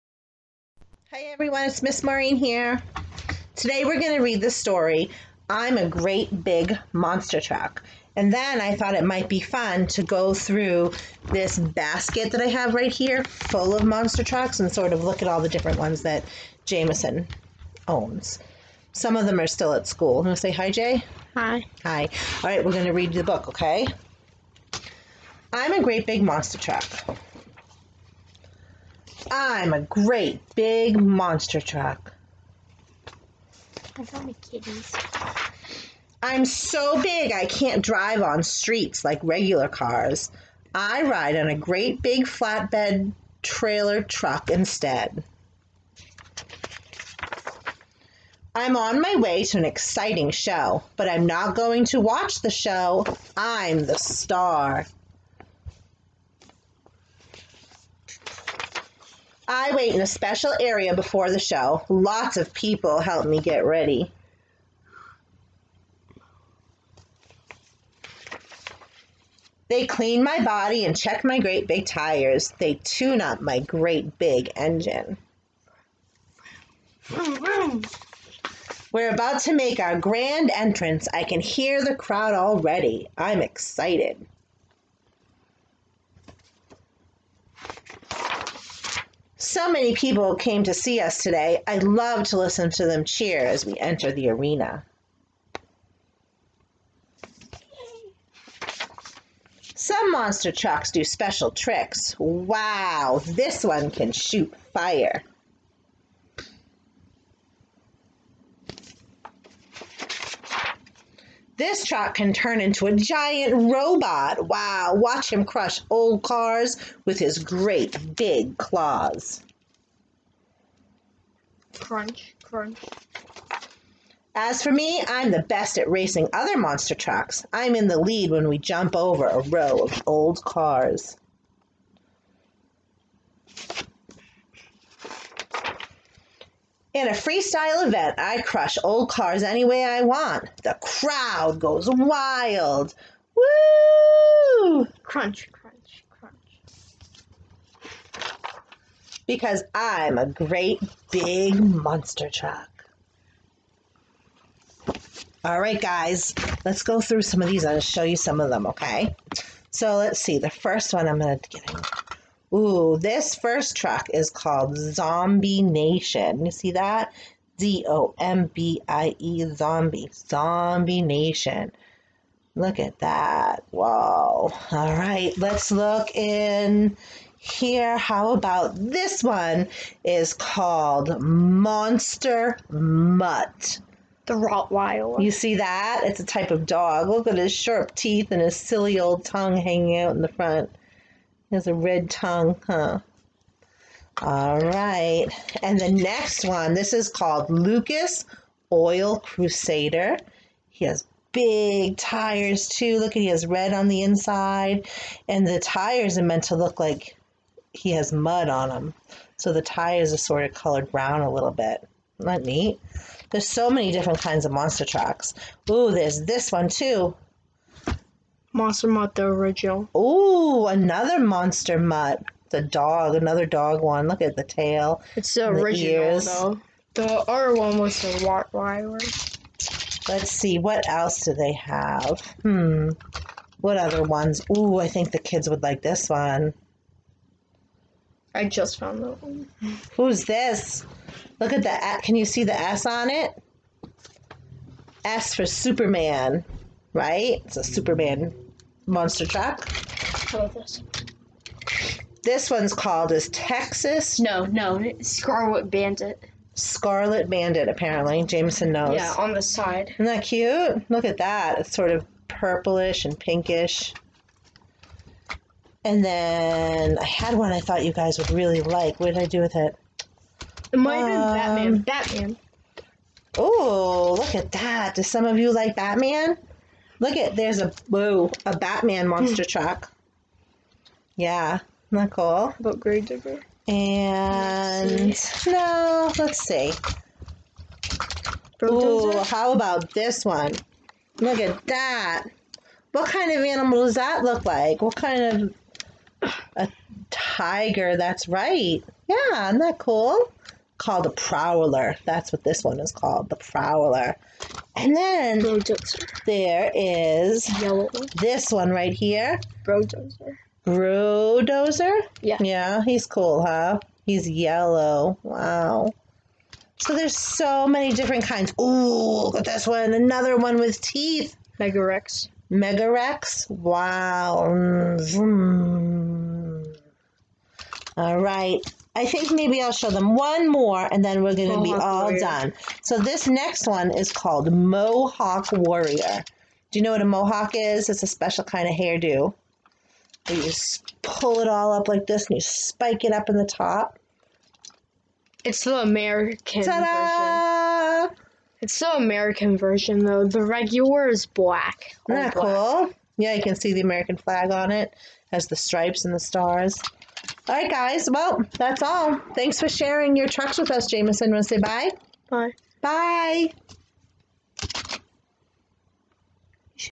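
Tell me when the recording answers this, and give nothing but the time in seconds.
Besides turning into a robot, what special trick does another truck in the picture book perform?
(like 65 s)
104 s.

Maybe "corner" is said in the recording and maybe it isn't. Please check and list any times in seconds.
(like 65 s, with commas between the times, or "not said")
not said.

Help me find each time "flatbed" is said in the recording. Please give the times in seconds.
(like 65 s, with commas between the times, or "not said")
42 s.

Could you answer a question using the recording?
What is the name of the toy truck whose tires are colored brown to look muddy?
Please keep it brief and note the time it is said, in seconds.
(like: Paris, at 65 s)
Lucas Oil Crusader, at 197 s.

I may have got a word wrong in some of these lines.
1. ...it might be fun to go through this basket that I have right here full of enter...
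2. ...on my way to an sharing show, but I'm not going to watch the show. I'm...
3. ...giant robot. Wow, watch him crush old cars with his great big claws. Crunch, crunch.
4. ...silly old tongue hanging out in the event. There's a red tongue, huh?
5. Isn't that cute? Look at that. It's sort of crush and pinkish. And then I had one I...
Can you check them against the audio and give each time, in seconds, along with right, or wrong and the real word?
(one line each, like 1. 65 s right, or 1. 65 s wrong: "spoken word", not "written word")
1. 8 s wrong: "monster", not "enter"
2. 48 s wrong: "exciting", not "sharing"
3. 112 s right
4. 188 s wrong: "front", not "event"
5. 259 s wrong: "purplish", not "crush".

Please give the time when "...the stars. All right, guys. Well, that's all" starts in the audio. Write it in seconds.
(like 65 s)
356 s.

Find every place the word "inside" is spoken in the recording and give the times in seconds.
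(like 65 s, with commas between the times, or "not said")
204 s.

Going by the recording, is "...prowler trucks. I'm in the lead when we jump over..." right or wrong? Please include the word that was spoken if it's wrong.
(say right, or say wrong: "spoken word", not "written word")
wrong: "monster", not "prowler".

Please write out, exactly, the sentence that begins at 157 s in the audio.
I'll show you some of them, okay?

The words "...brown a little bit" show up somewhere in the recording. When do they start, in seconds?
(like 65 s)
210 s.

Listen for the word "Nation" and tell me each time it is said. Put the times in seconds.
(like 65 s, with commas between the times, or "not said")
165 s, 171 s.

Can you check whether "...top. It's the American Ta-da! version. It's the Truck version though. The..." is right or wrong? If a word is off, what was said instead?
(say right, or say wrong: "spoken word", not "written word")
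wrong: "American", not "Truck".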